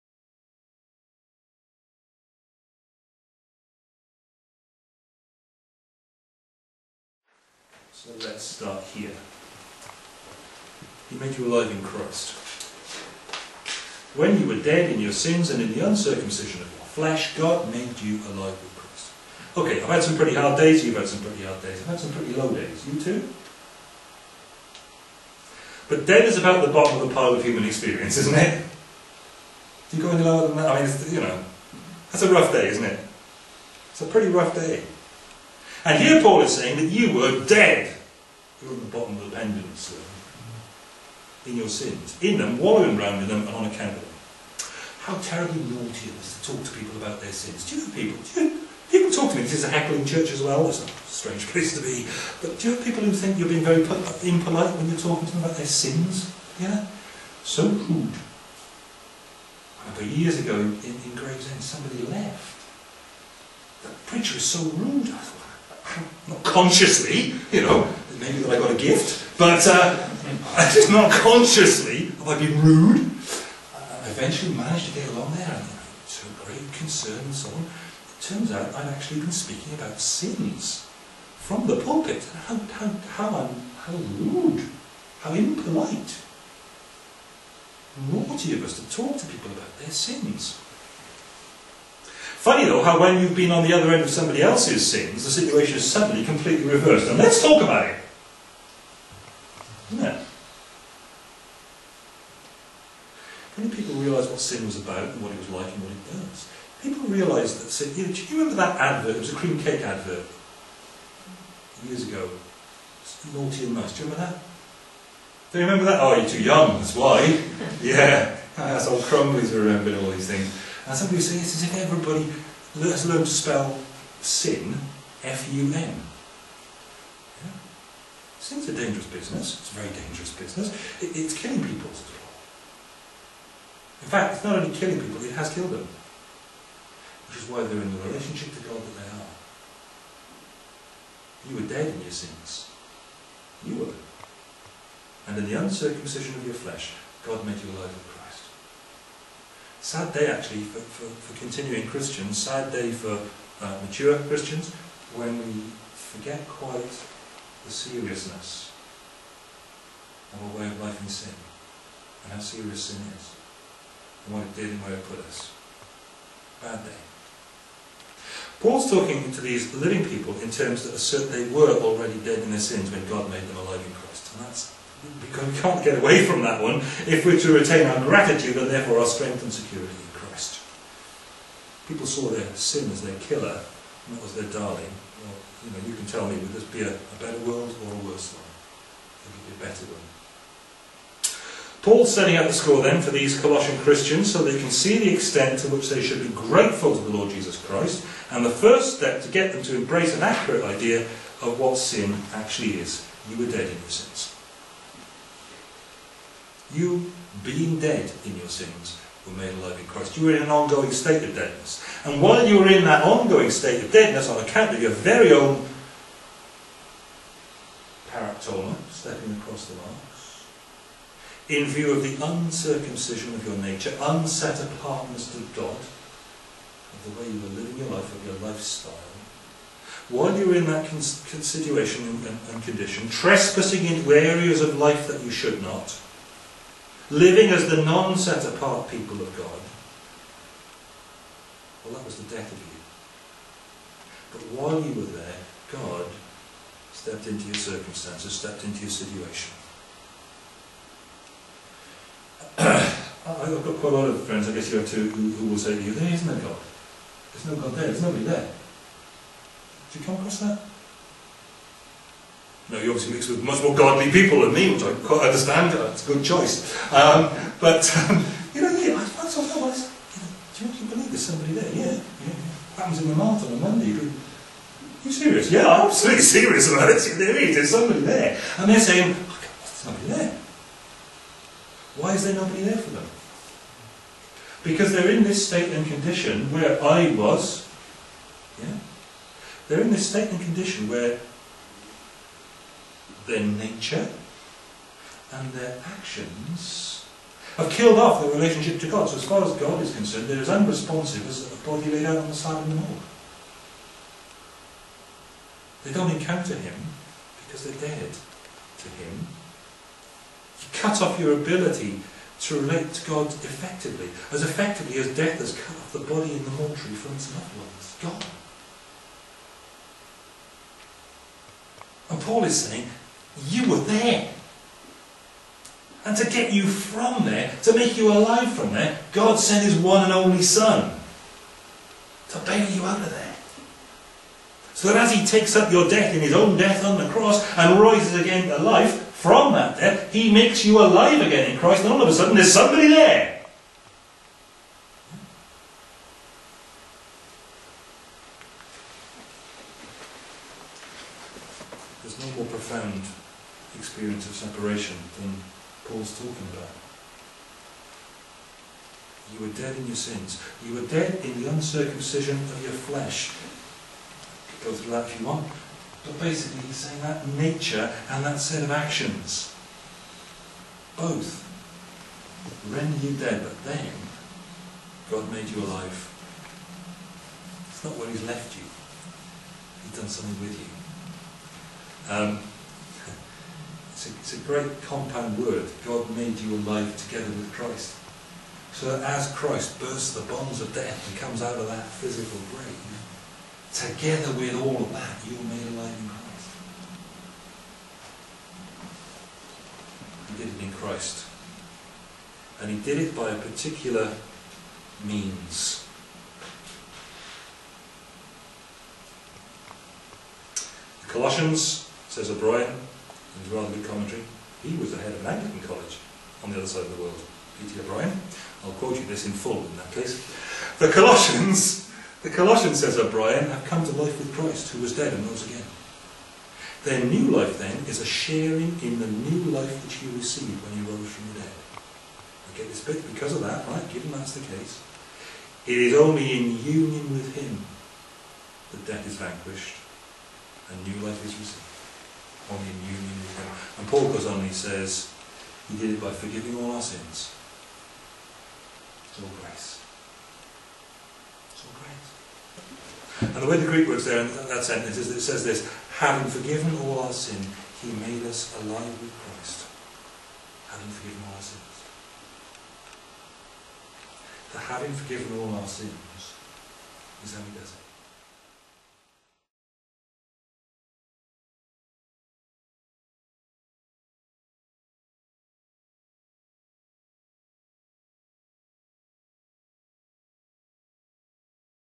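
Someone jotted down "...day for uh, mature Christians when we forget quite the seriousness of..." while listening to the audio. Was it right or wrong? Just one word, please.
right.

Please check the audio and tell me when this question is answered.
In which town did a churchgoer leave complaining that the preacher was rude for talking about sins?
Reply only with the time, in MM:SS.
01:01.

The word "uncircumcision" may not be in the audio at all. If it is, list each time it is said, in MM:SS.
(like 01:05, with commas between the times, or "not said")
00:15, 02:25, 03:42, 06:01.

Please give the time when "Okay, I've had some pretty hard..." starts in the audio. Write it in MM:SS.
00:19.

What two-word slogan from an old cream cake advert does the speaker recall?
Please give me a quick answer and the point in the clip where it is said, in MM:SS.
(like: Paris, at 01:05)
Naughty and nice, at 01:53.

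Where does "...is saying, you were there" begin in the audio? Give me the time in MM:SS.
05:22.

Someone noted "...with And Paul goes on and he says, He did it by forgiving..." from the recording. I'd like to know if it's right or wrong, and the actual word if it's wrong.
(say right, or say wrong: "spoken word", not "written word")
right.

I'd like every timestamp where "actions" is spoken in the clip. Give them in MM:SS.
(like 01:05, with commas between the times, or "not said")
04:55, 06:08.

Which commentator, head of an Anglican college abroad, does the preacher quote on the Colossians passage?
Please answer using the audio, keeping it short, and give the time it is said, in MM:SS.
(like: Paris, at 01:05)
P.T. O'Brien, at 06:57.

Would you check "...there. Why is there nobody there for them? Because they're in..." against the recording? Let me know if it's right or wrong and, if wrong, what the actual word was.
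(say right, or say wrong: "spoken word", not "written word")
right.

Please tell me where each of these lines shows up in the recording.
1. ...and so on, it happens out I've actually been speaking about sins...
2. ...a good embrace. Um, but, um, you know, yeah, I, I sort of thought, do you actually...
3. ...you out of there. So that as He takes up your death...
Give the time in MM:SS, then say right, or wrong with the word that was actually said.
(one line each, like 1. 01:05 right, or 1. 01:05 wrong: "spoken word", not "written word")
1. 01:17 wrong: "turns", not "happens"
2. 04:26 wrong: "choice", not "embrace"
3. 05:32 right.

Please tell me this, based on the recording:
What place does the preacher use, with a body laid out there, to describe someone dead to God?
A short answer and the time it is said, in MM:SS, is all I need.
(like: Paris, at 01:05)
the morgue, at 05:02.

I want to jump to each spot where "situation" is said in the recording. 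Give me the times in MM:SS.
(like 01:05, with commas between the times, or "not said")
01:35, 03:51, 04:08.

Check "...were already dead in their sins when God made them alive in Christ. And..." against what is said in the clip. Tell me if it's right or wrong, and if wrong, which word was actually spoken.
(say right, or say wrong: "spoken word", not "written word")
right.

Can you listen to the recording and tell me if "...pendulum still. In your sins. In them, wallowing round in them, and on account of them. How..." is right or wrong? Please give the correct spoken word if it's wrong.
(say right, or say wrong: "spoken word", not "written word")
right.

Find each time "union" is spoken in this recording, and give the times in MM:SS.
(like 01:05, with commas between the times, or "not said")
07:16, 07:22.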